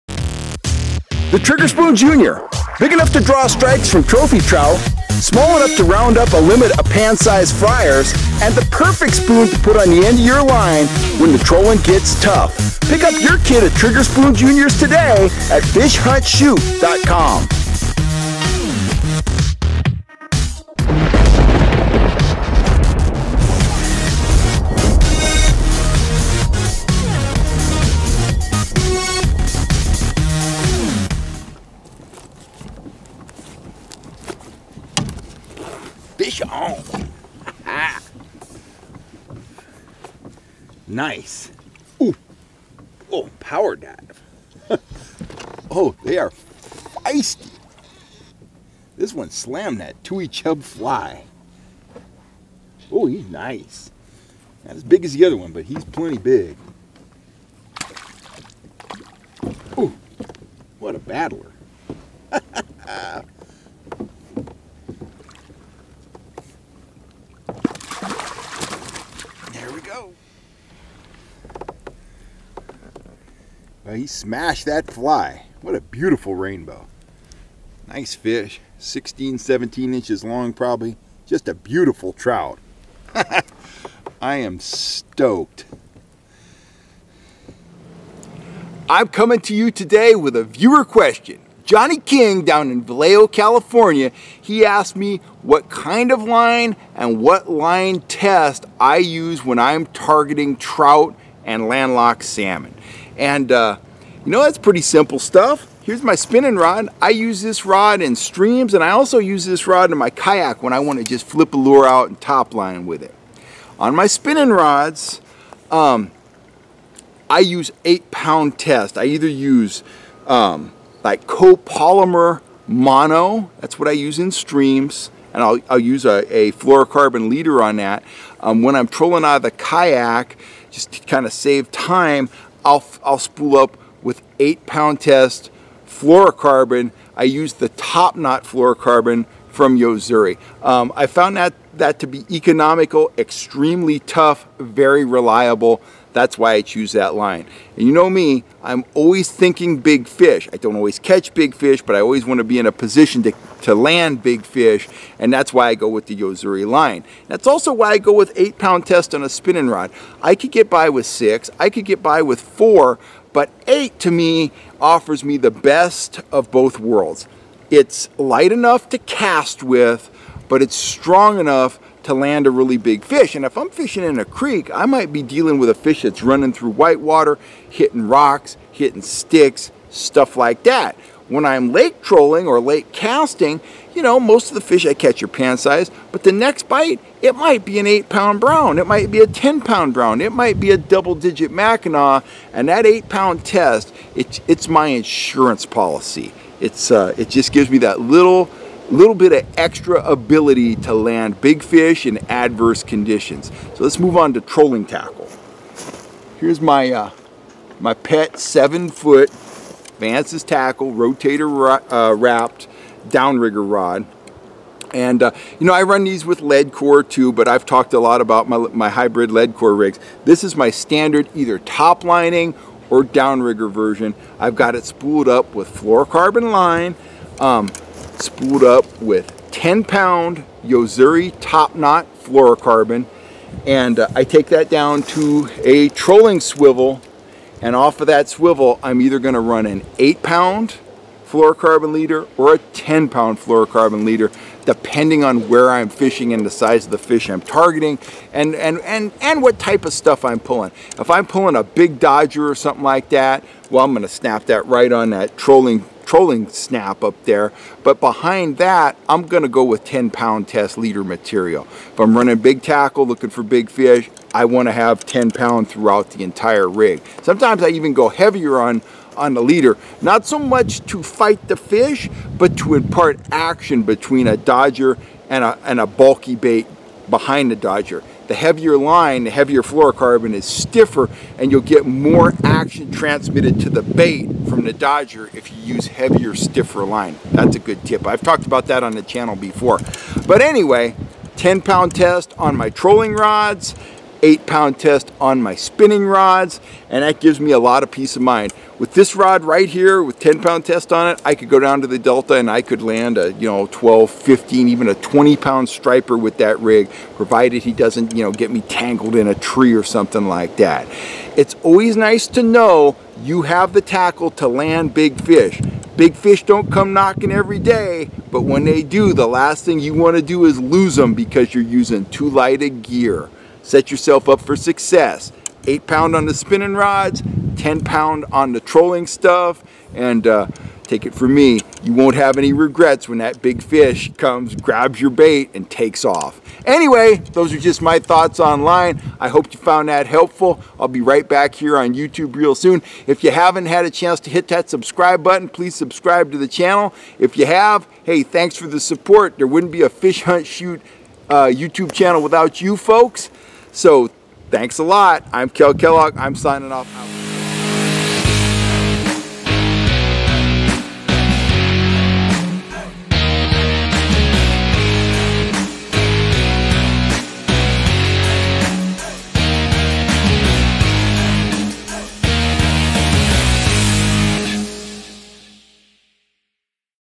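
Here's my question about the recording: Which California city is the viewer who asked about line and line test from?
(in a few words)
Vallejo.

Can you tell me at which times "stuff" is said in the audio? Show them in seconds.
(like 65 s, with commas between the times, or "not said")
105 s, 179 s, 249 s, 329 s.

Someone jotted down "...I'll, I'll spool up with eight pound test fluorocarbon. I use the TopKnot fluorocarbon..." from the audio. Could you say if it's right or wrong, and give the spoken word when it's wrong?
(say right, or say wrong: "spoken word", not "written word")
right.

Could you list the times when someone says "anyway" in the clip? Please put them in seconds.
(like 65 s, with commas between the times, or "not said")
290 s, 336 s.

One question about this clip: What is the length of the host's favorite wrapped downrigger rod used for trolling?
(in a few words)
7 feet.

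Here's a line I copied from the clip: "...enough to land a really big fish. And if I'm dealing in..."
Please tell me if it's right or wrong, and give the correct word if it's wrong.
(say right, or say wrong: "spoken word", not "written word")
wrong: "fishing", not "dealing".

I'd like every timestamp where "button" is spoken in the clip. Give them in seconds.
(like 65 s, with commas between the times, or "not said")
345 s.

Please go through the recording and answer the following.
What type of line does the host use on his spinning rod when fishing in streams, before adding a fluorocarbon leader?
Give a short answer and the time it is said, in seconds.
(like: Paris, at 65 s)
copolymer mono, at 121 s.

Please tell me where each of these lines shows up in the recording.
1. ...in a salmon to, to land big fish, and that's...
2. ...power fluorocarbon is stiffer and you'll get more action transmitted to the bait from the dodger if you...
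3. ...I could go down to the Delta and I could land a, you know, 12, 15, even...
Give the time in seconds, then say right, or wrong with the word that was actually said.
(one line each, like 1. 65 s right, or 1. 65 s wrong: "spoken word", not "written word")
1. 152 s wrong: "position", not "salmon"
2. 279 s wrong: "heavier", not "power"
3. 301 s right.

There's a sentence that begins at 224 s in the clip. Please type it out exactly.
I've got it spooled up with fluorocarbon line um, spooled up with 10 pound Yo-Zuri top knot fluorocarbon.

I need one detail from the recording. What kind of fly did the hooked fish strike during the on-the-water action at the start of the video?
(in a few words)
Tui Chub fly.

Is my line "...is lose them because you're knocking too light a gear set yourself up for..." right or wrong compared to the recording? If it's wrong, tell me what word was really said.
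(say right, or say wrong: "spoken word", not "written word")
wrong: "using", not "knocking".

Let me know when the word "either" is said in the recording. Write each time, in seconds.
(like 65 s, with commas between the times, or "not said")
119 s, 221 s, 239 s.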